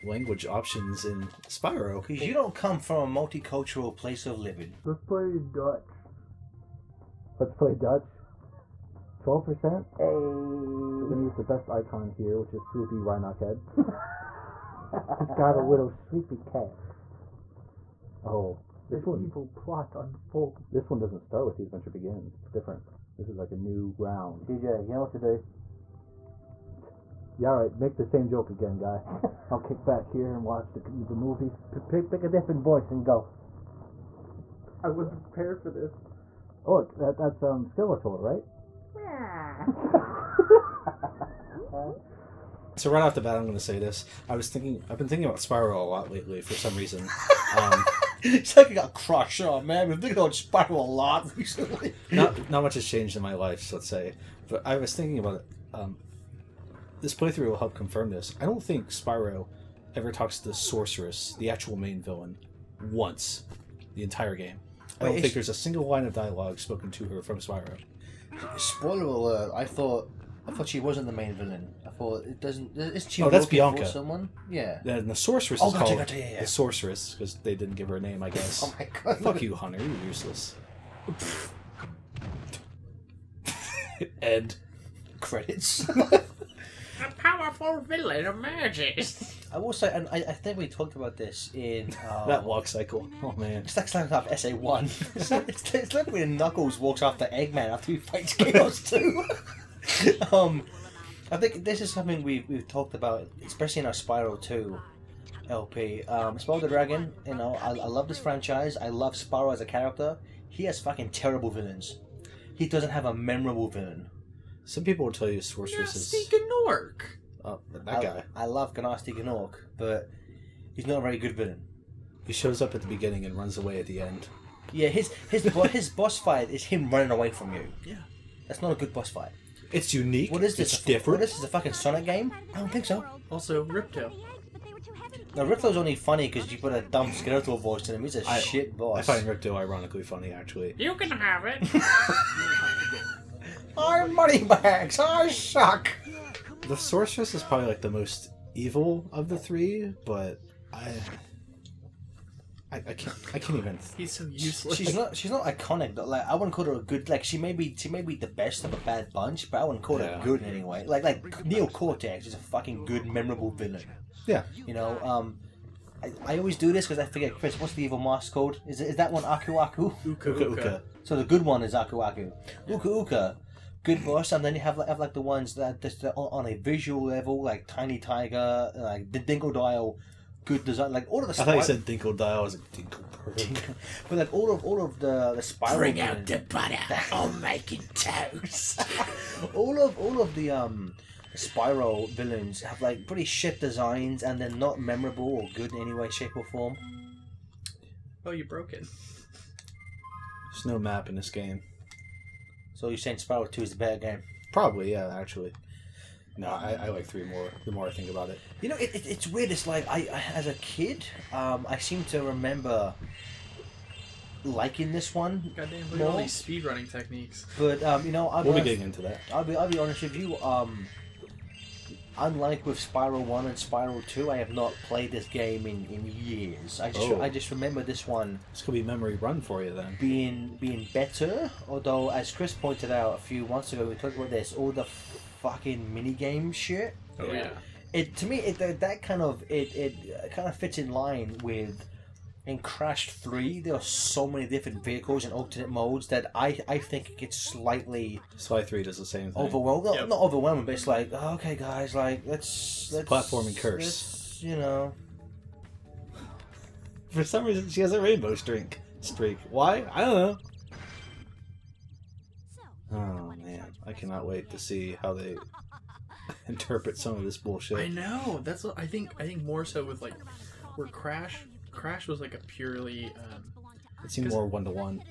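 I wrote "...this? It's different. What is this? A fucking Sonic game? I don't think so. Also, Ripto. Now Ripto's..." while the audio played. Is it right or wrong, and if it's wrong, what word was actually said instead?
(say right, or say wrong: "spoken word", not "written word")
right.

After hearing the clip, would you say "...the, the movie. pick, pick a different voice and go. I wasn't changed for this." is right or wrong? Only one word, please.
wrong.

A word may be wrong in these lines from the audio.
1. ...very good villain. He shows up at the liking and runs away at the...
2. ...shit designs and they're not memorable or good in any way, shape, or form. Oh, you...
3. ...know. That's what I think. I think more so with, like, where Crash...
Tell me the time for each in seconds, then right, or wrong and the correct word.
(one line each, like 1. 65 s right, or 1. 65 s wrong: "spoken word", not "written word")
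1. 120 s wrong: "beginning", not "liking"
2. 193 s right
3. 267 s right.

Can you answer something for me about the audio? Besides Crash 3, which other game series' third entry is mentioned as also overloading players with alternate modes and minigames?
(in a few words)
Sly 3.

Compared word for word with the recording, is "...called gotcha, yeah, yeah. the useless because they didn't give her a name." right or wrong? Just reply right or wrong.
wrong.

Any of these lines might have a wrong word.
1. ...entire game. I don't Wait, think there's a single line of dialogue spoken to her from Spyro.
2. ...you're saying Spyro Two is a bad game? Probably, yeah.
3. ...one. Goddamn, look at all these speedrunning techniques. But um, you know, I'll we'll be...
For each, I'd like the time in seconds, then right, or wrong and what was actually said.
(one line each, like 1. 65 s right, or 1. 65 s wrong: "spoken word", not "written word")
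1. 64 s right
2. 202 s right
3. 215 s right.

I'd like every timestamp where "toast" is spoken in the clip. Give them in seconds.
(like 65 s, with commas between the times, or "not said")
187 s.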